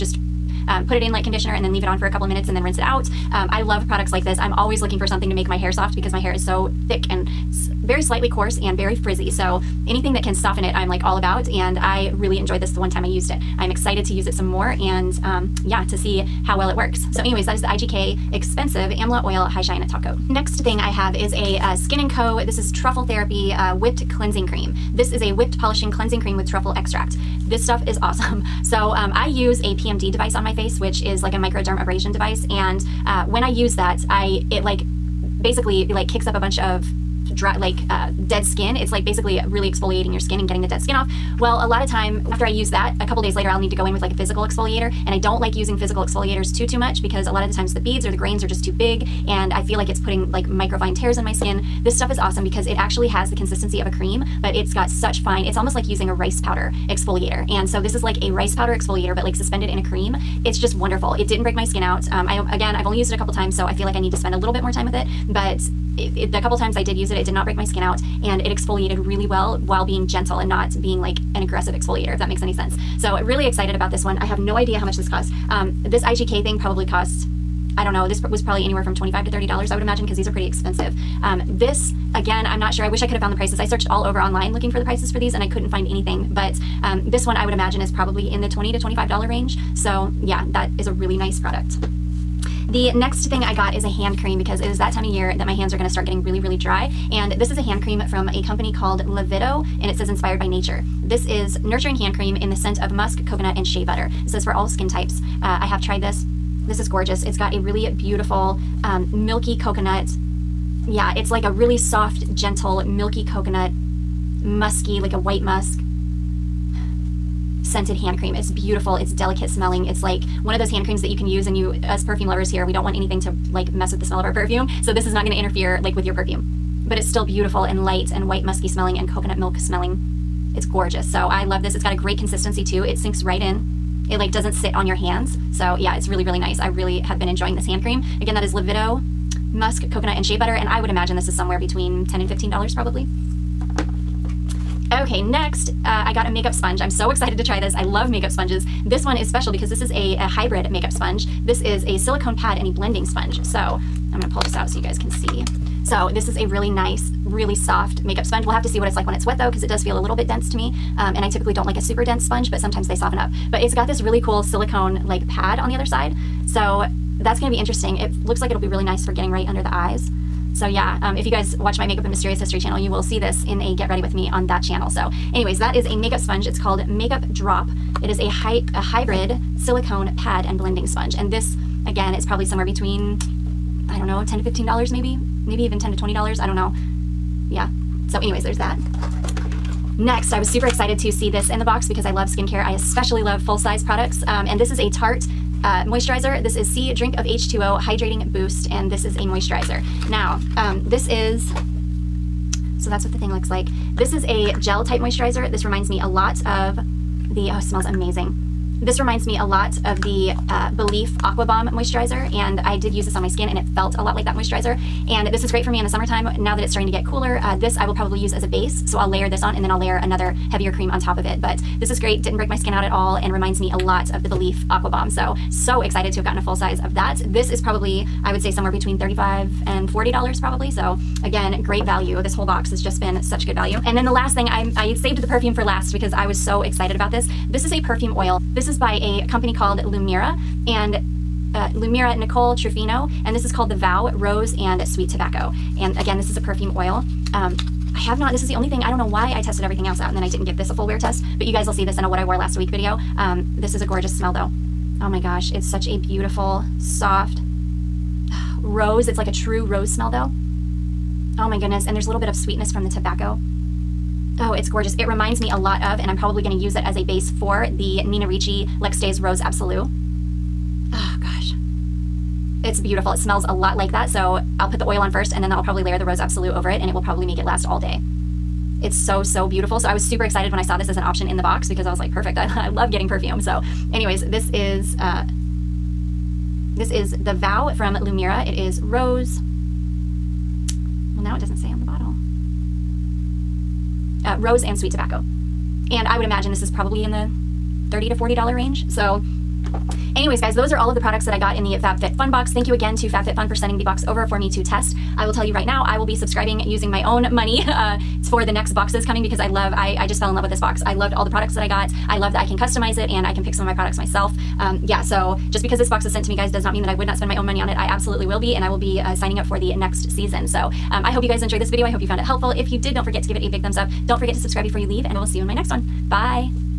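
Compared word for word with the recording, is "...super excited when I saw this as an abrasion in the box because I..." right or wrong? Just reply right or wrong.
wrong.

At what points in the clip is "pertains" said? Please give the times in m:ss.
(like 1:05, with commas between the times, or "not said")
not said.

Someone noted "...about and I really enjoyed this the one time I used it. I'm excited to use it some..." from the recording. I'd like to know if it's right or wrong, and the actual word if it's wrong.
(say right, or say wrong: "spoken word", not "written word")
right.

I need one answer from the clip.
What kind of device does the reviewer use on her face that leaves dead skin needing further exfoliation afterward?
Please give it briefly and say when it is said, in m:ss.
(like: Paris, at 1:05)
PMD device, at 0:29.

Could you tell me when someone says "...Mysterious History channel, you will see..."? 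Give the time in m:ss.
2:52.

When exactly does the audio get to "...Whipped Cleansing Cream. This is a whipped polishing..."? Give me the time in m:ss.
0:23.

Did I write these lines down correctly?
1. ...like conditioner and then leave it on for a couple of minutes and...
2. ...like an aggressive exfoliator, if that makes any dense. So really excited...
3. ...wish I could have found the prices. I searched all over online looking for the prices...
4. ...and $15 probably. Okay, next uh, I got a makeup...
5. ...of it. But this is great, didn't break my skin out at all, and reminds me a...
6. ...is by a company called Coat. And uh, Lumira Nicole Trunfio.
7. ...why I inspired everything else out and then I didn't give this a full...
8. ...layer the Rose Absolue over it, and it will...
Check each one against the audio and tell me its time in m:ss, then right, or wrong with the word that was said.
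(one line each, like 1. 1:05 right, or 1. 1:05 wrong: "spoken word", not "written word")
1. 0:01 right
2. 1:11 wrong: "sense", not "dense"
3. 1:22 right
4. 2:22 right
5. 3:41 right
6. 3:58 wrong: "Lumira", not "Coat"
7. 4:09 wrong: "tested", not "inspired"
8. 4:35 right.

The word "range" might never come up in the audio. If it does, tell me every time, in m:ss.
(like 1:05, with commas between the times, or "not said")
1:29, 4:58.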